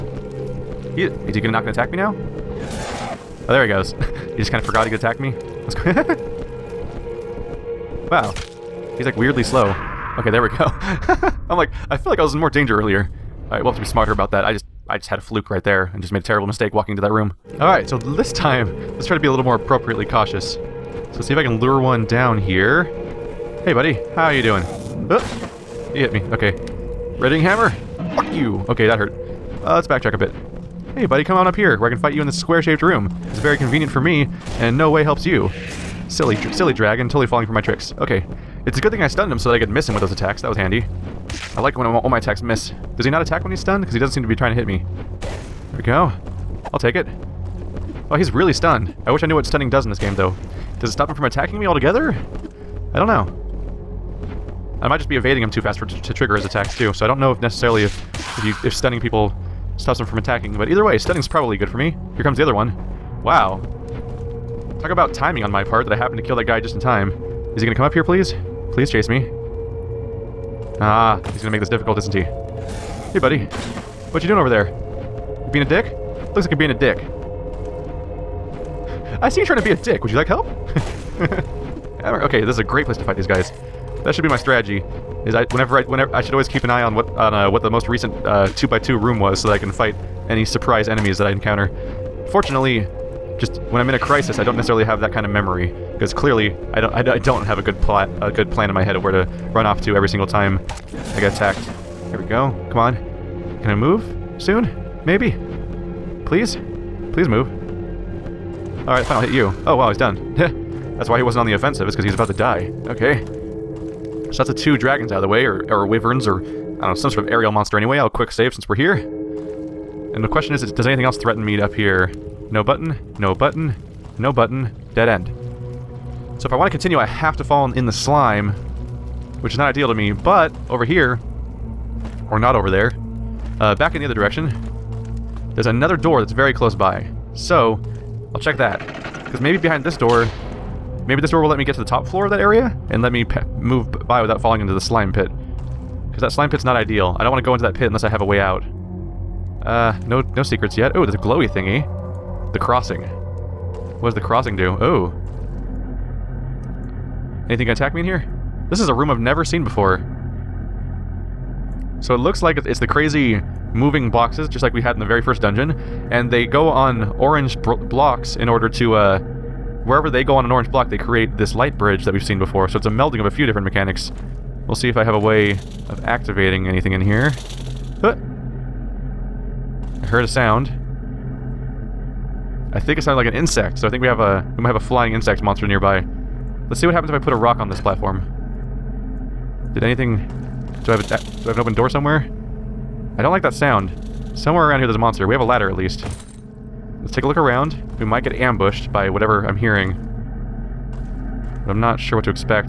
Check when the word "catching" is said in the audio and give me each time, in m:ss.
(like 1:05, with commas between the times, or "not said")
not said.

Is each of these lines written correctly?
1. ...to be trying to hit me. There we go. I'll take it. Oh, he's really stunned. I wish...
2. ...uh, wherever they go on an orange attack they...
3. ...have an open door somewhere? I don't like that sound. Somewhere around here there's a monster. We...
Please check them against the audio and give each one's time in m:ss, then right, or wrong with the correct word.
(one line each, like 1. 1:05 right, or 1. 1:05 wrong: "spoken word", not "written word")
1. 0:44 right
2. 2:48 wrong: "block", not "attack"
3. 3:11 right.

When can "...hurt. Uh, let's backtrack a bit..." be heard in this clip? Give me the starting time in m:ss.
0:28.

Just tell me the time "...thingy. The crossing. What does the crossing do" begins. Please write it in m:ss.
2:31.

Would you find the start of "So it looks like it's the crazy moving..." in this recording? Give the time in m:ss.
2:41.